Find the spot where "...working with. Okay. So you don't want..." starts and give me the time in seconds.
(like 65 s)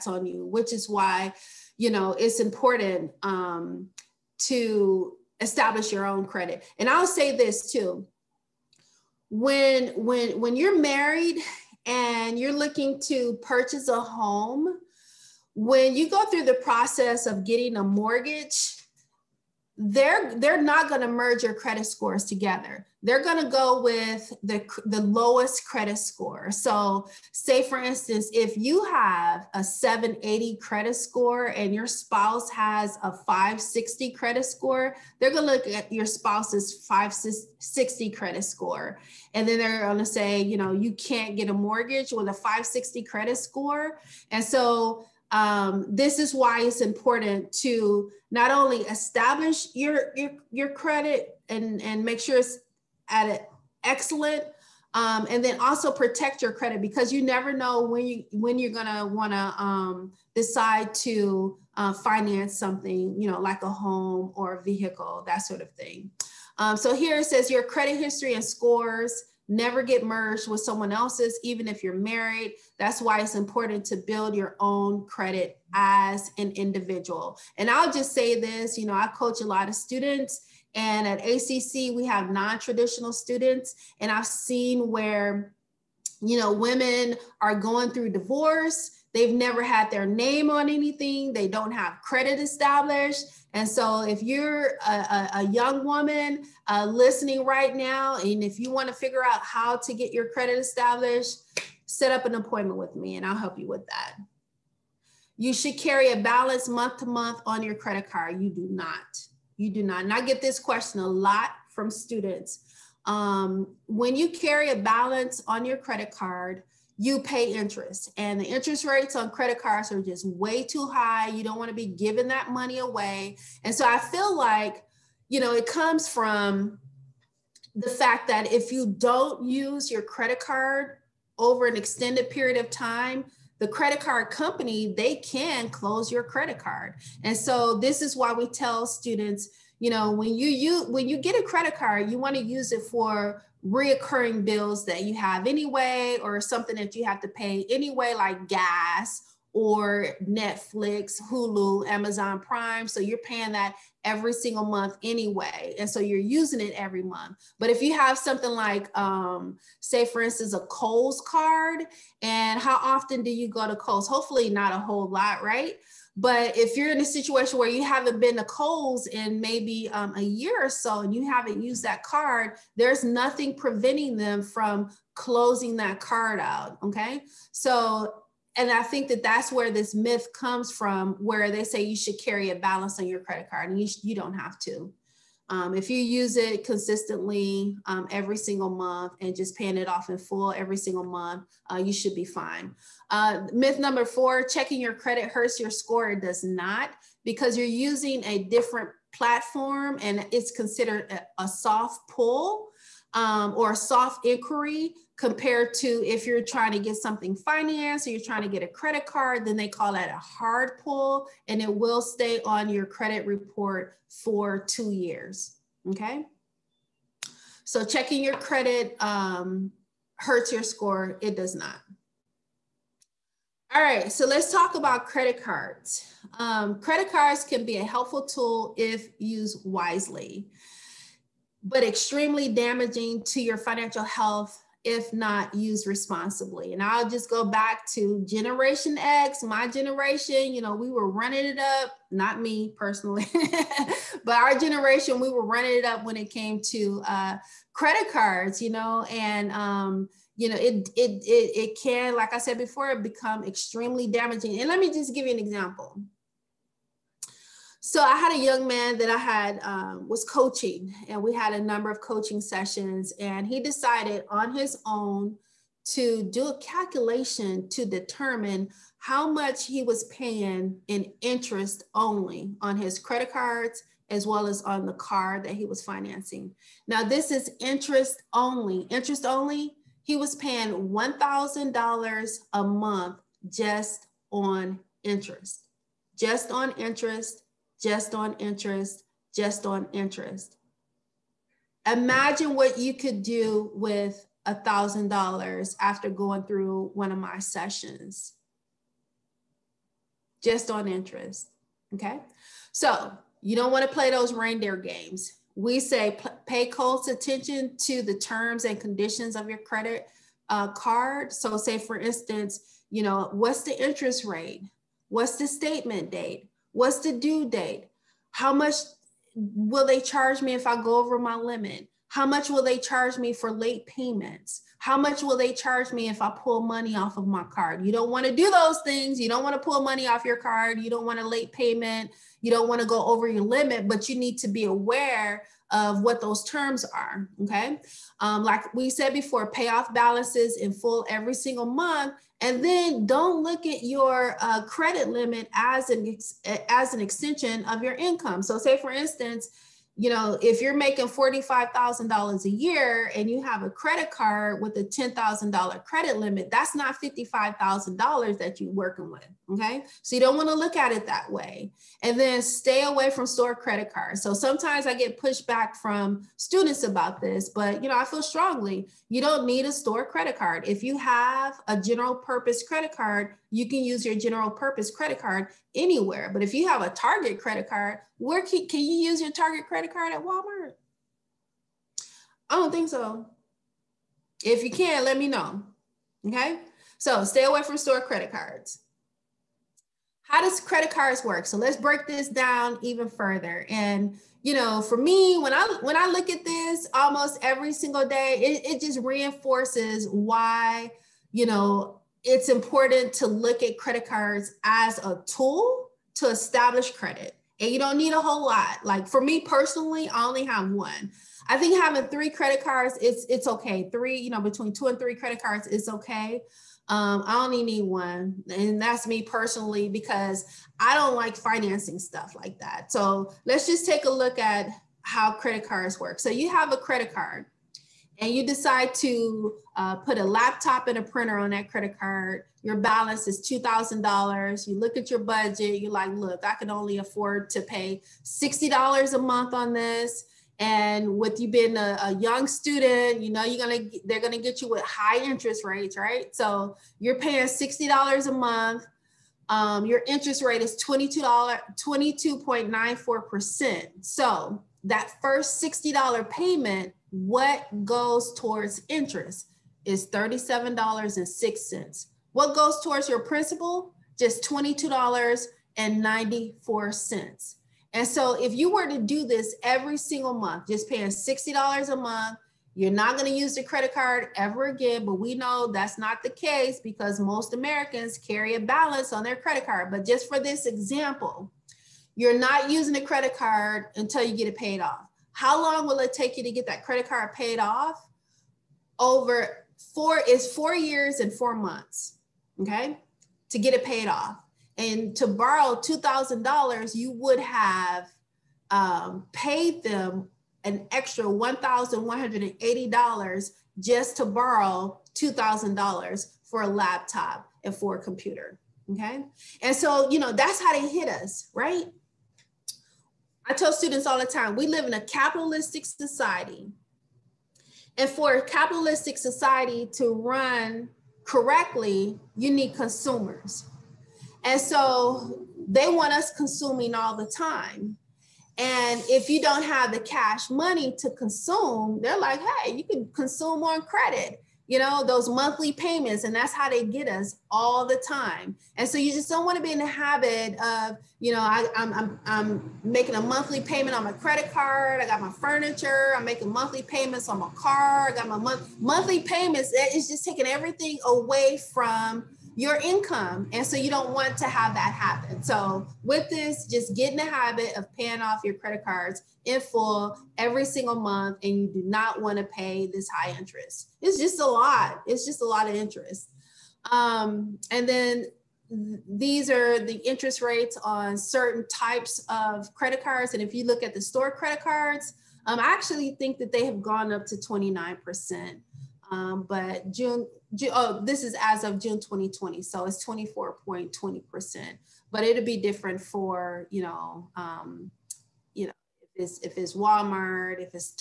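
358 s.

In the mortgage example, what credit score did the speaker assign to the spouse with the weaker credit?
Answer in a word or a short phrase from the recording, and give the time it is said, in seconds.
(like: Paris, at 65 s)
560, at 42 s.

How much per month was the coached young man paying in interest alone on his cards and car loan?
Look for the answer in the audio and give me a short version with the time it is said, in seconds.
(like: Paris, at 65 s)
$1,000, at 280 s.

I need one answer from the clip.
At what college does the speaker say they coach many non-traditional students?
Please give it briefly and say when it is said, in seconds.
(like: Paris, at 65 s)
ACC, at 81 s.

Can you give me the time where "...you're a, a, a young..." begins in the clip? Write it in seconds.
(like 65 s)
94 s.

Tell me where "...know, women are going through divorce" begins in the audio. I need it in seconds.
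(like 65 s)
86 s.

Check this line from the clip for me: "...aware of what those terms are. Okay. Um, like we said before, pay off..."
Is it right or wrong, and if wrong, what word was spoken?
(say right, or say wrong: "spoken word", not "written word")
right.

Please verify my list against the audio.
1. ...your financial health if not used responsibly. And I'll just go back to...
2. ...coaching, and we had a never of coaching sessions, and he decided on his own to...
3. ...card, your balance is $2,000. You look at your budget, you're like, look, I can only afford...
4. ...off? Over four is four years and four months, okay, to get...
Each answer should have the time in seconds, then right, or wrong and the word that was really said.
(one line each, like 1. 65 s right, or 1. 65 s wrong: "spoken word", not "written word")
1. 233 s right
2. 260 s wrong: "number", not "never"
3. 431 s right
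4. 487 s right.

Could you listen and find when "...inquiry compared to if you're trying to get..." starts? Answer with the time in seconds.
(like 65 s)
204 s.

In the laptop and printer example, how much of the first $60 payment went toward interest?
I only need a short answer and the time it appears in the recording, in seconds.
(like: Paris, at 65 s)
$37.06, at 460 s.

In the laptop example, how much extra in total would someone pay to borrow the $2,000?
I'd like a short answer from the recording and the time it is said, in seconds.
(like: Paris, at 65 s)
$1,180, at 501 s.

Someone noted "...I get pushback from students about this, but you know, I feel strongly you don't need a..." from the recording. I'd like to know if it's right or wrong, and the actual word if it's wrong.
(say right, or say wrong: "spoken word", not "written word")
right.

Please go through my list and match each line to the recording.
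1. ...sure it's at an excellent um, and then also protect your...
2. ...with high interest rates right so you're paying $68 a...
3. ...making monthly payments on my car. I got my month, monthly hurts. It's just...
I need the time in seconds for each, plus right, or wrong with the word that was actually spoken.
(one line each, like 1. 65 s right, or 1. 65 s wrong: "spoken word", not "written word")
1. 52 s right
2. 444 s wrong: "60", not "68"
3. 546 s wrong: "payments", not "hurts".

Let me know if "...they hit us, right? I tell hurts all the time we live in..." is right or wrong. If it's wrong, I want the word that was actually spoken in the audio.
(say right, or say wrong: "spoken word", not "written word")
wrong: "students", not "hurts".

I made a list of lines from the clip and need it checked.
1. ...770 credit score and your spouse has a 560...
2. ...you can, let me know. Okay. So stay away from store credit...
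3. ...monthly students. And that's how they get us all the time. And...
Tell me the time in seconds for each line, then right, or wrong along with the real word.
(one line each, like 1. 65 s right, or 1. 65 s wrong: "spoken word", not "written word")
1. 29 s wrong: "780", not "770"
2. 384 s right
3. 535 s wrong: "payments", not "students".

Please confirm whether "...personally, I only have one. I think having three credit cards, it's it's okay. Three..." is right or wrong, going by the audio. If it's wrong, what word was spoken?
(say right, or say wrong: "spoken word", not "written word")
right.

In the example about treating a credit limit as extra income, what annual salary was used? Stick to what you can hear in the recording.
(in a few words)
$45,000.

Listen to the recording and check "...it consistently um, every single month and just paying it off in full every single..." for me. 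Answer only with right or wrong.
right.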